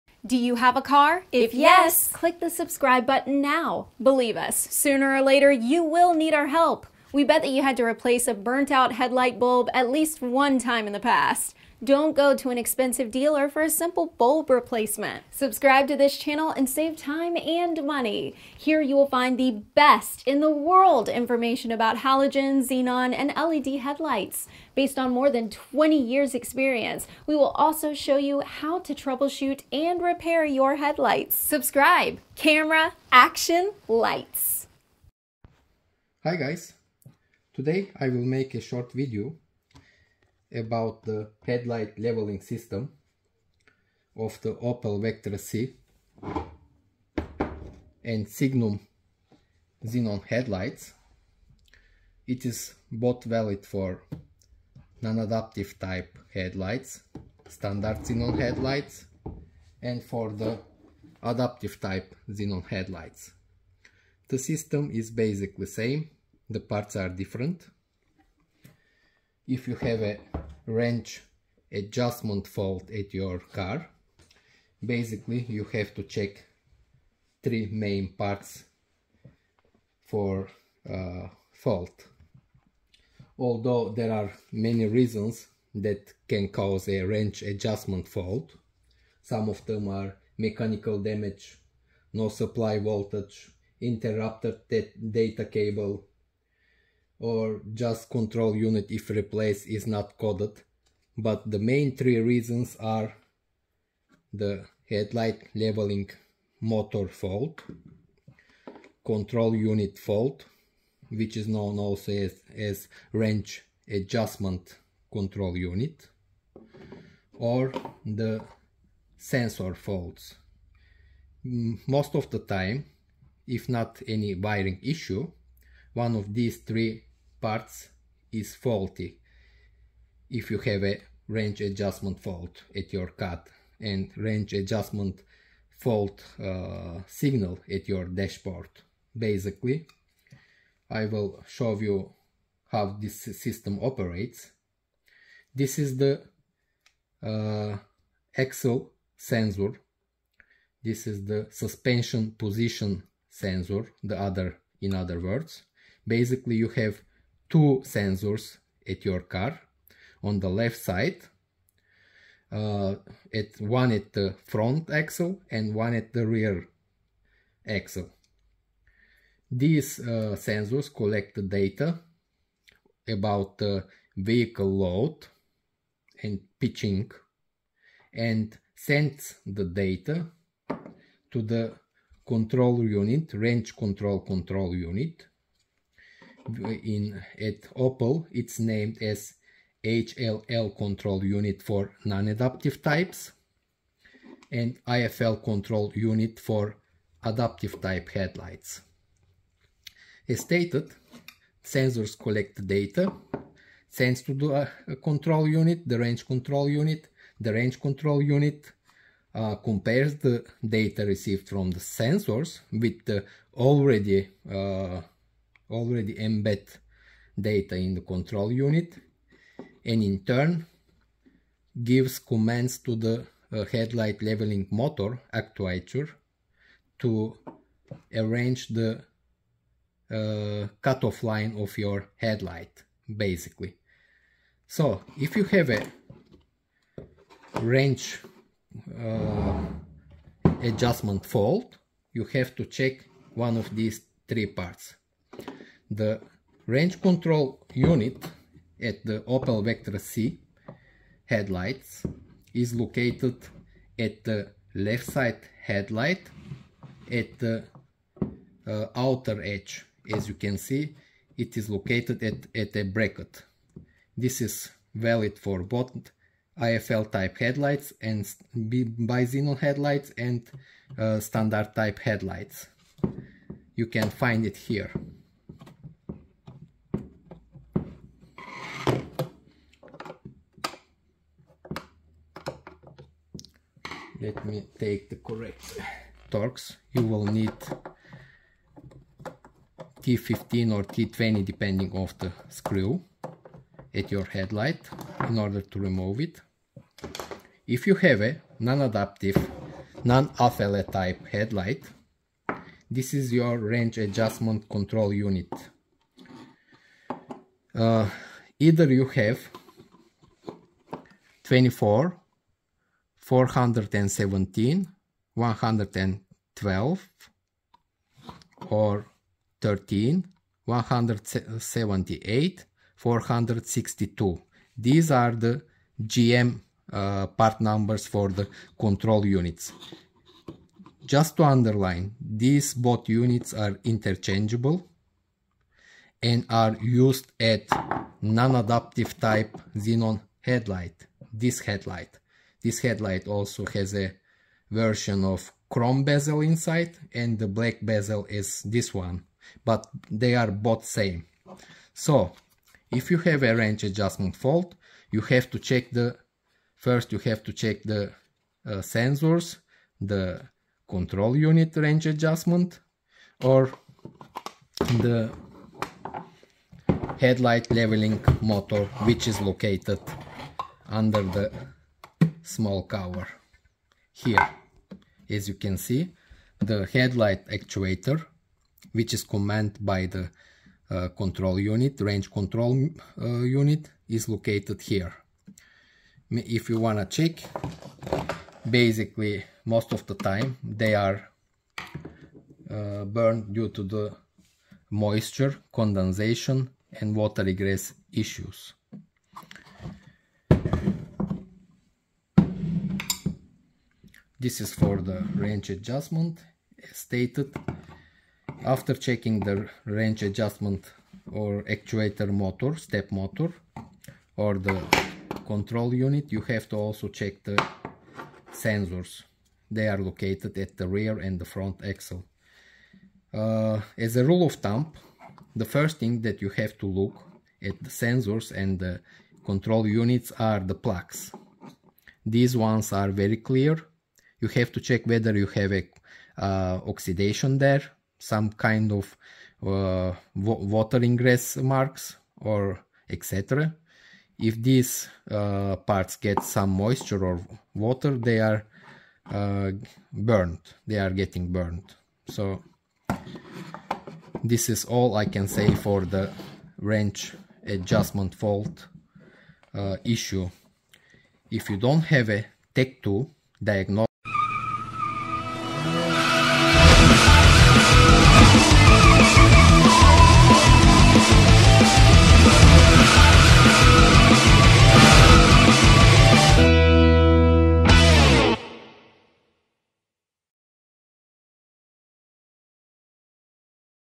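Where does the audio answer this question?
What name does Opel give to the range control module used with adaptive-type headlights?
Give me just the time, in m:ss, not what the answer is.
3:14.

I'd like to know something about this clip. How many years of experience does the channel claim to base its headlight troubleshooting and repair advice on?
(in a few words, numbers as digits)
More than 20.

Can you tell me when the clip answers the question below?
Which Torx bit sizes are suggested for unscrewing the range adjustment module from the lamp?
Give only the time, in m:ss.
4:50.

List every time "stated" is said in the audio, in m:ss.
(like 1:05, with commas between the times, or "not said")
3:20, 6:46.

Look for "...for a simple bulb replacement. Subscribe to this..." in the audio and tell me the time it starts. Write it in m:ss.
0:13.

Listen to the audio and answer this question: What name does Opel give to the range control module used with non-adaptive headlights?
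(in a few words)
HLL control unit.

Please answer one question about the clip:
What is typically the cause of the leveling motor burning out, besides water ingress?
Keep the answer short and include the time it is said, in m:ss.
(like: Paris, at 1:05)
Moisture condensation, at 6:34.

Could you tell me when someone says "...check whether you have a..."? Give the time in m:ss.
7:14.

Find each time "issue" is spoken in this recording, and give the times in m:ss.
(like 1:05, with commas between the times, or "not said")
2:04, 6:38, 7:40.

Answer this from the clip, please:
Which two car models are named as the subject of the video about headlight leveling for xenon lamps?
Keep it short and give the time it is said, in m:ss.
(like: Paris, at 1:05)
Opel Vectra C and Signum, at 0:44.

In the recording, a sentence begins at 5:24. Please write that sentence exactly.
These are the GM uh, part numbers for the control units.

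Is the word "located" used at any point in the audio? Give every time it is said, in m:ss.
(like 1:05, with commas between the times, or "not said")
4:12, 4:21, 6:09, 6:24, 6:59.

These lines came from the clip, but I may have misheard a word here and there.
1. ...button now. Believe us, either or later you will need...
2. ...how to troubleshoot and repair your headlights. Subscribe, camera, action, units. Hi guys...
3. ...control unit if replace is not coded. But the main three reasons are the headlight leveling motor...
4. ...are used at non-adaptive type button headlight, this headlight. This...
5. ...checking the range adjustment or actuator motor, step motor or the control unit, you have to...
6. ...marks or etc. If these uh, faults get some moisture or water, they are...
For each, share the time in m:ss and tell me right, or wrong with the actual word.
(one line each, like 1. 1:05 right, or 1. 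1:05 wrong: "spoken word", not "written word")
1. 0:03 wrong: "sooner", not "either"
2. 0:28 wrong: "lights", not "units"
3. 1:38 right
4. 5:36 wrong: "xenon", not "button"
5. 6:48 right
6. 7:21 wrong: "parts", not "faults".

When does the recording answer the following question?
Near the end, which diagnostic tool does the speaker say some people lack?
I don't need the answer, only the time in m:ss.
7:42.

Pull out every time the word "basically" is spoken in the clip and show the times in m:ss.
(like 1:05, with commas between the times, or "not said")
1:05, 1:14, 2:19, 2:36, 3:53, 6:28.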